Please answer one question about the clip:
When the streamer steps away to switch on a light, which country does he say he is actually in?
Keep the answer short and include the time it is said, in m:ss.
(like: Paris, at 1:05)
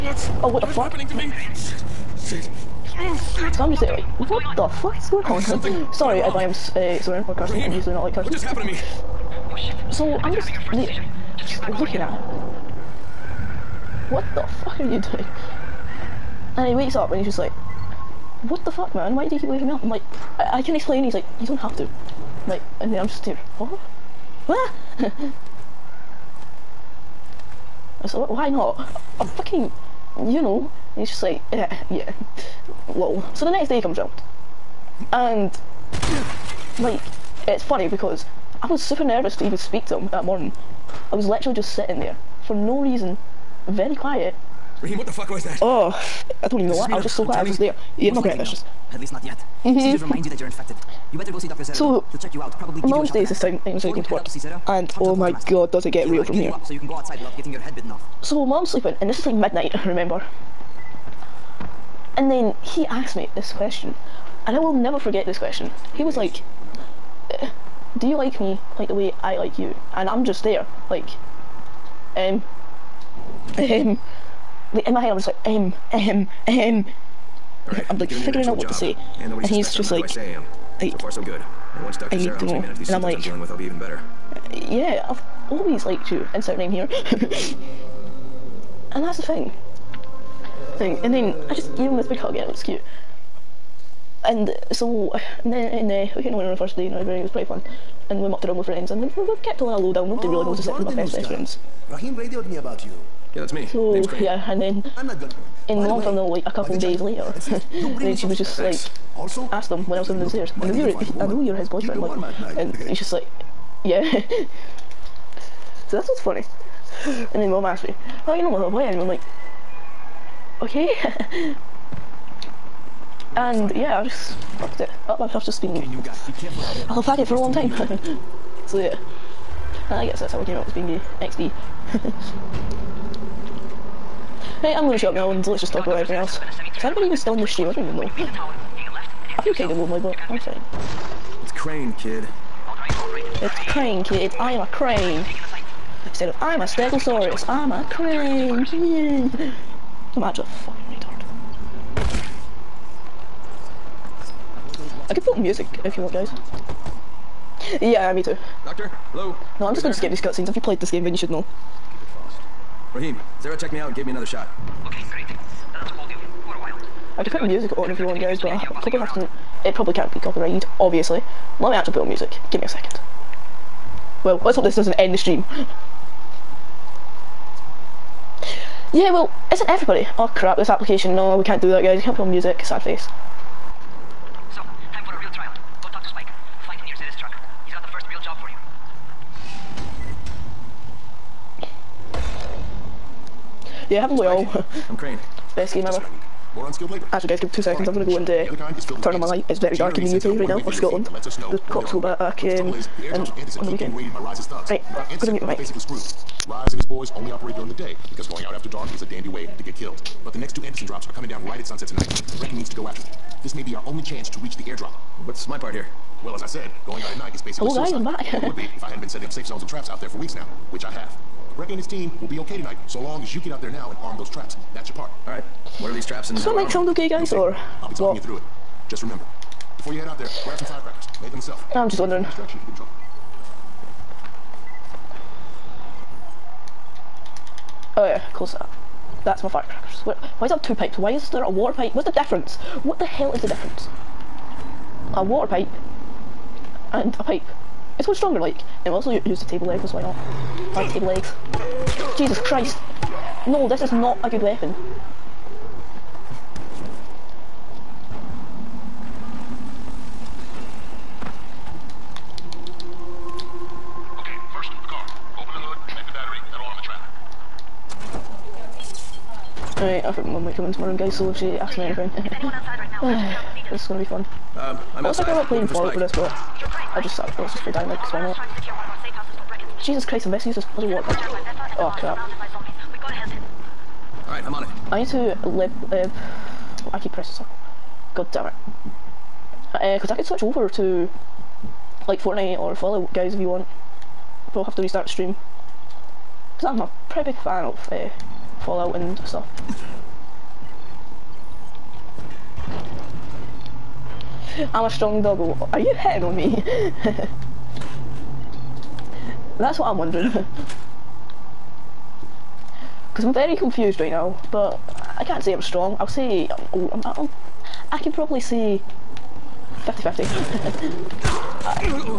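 Scotland, at 3:20.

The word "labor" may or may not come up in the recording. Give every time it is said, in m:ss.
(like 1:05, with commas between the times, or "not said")
3:16.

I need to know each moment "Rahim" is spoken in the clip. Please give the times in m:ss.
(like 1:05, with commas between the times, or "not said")
0:07, 0:44, 1:41, 2:42.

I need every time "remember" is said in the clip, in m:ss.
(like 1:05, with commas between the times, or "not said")
0:59, 3:49.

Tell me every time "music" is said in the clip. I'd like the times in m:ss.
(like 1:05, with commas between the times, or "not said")
2:35, 2:47, 2:52, 3:02.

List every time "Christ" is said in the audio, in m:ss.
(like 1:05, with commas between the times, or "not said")
4:12, 4:40.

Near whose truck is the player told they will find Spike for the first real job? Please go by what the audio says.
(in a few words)
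Zed.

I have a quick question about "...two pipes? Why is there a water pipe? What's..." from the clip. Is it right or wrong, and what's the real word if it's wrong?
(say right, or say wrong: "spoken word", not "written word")
right.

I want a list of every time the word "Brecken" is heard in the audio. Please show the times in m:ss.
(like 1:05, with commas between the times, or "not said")
3:32, 3:41.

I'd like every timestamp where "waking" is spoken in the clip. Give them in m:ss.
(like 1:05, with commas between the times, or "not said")
0:19.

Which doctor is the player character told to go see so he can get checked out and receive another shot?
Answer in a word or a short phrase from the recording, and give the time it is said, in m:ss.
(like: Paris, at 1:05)
Dr. Zere, at 0:51.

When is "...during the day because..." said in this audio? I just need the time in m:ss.
3:27.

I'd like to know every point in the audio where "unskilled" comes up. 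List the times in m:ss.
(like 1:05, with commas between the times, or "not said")
3:16.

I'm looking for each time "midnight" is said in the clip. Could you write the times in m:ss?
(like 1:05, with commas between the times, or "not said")
0:59.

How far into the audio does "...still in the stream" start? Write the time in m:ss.
2:17.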